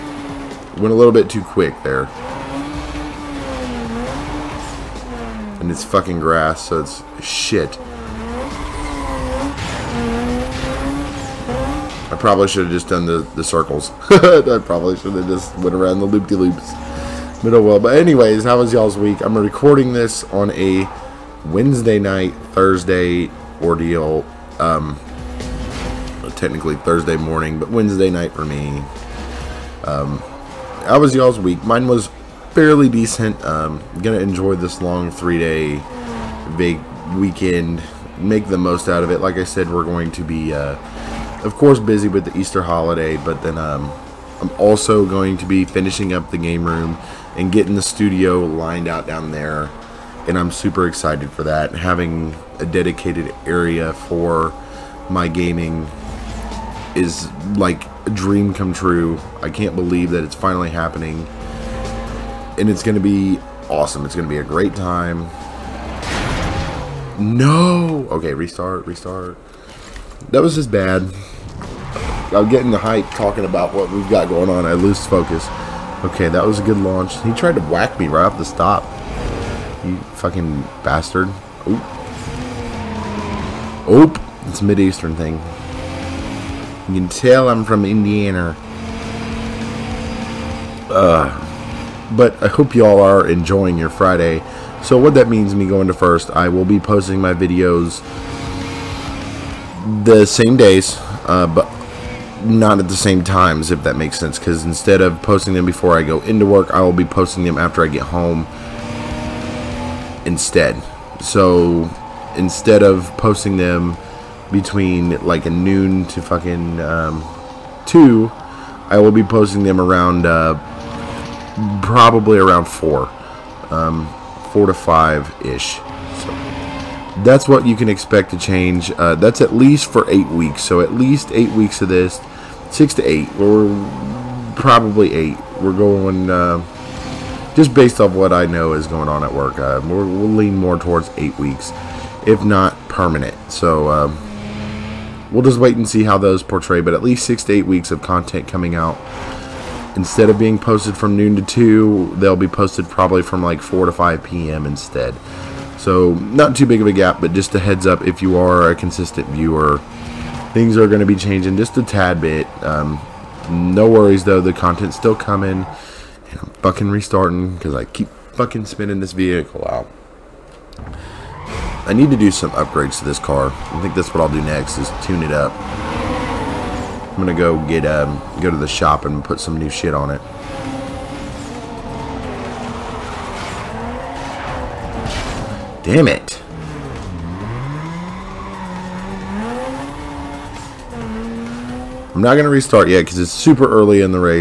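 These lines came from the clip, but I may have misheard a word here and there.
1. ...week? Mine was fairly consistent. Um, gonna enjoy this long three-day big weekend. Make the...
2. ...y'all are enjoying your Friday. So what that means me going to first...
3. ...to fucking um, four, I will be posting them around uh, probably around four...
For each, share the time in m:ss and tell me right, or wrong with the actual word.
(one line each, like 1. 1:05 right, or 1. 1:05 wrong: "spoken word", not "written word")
1. 0:31 wrong: "decent", not "consistent"
2. 1:32 right
3. 1:56 wrong: "two", not "four".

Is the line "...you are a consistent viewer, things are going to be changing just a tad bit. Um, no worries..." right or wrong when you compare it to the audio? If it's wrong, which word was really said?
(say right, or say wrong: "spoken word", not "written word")
right.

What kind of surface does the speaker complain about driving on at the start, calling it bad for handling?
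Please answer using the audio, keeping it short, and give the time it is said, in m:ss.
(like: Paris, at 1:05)
grass, at 0:06.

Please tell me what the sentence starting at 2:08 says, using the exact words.
Uh, that's at least for eight weeks.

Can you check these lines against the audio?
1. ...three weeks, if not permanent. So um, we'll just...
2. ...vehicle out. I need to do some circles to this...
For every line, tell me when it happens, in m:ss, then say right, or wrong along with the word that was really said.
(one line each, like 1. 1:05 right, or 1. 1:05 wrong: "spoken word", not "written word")
1. 2:21 wrong: "eight", not "three"
2. 2:49 wrong: "upgrades", not "circles".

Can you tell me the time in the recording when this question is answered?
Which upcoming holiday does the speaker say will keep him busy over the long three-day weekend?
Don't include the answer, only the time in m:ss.
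0:42.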